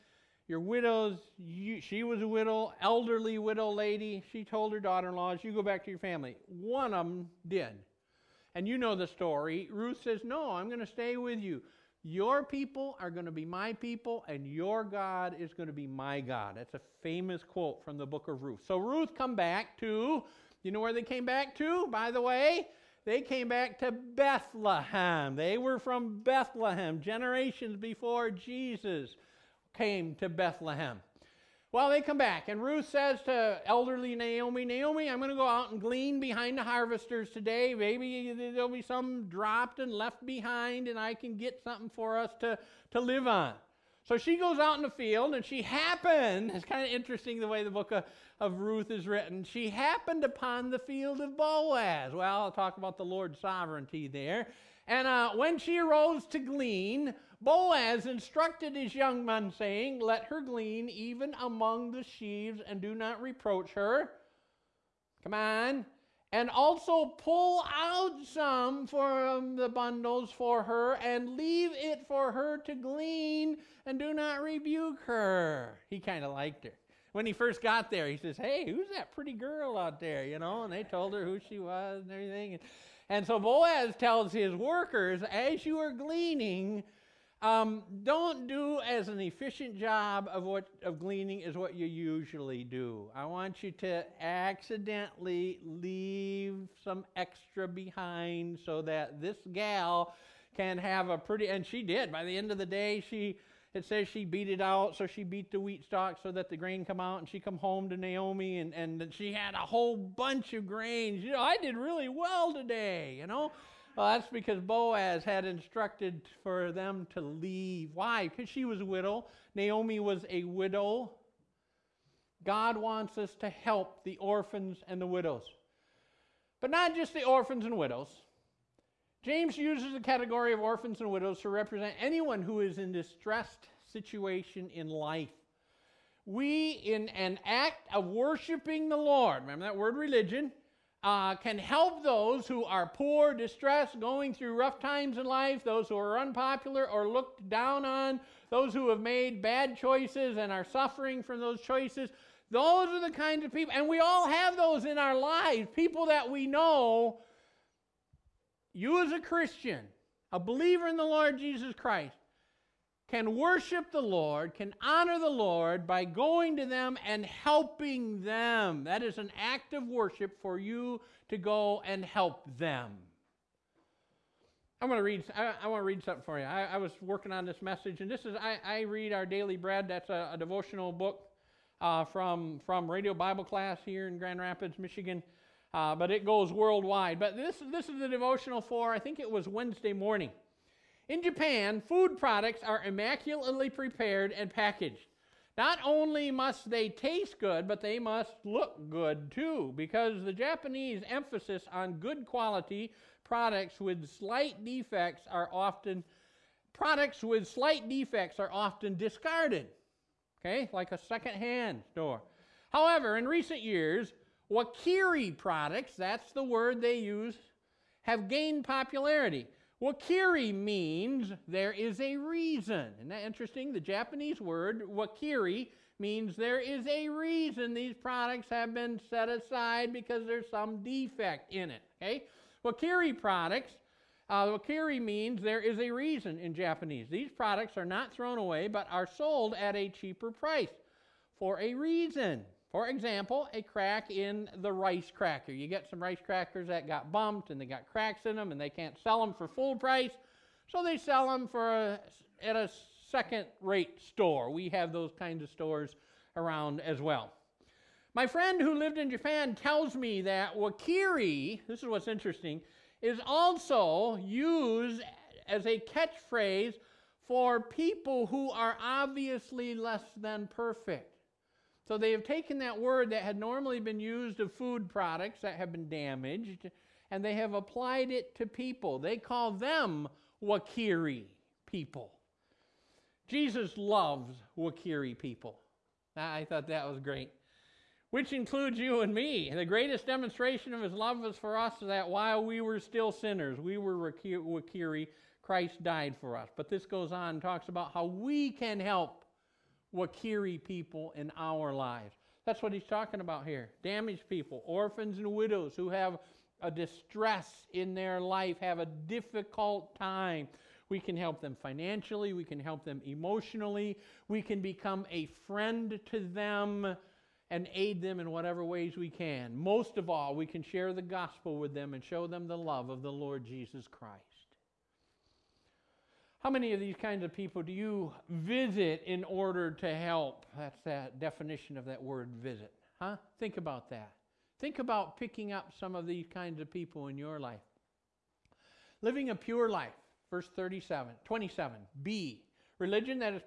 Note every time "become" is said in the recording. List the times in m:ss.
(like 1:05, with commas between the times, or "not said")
5:14.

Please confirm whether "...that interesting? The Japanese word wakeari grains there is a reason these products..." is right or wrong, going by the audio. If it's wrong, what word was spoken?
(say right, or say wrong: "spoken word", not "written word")
wrong: "means", not "grains".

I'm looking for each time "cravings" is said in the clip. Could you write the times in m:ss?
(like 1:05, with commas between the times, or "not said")
not said.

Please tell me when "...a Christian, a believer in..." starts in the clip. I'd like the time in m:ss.
2:39.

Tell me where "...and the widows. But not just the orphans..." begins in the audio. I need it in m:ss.
2:04.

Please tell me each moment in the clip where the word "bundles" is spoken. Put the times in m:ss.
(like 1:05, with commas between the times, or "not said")
1:09.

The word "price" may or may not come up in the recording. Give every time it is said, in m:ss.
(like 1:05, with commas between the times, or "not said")
4:00, 4:09.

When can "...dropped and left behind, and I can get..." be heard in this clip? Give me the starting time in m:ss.
0:39.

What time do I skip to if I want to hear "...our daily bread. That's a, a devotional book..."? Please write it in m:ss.
2:59.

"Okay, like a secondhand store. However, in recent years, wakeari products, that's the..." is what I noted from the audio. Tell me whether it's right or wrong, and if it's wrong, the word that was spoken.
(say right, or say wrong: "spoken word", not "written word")
right.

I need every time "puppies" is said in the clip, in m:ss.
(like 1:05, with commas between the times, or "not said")
not said.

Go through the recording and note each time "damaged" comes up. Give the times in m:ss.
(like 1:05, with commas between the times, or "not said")
4:35, 5:03.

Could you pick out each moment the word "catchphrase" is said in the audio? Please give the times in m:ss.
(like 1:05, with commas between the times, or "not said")
4:25.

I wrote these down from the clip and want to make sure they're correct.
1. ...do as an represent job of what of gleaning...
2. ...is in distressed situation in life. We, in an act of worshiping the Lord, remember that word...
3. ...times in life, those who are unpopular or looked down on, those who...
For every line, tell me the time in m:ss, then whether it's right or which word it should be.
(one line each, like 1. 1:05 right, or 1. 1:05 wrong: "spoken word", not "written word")
1. 1:28 wrong: "efficient", not "represent"
2. 2:12 right
3. 2:24 right.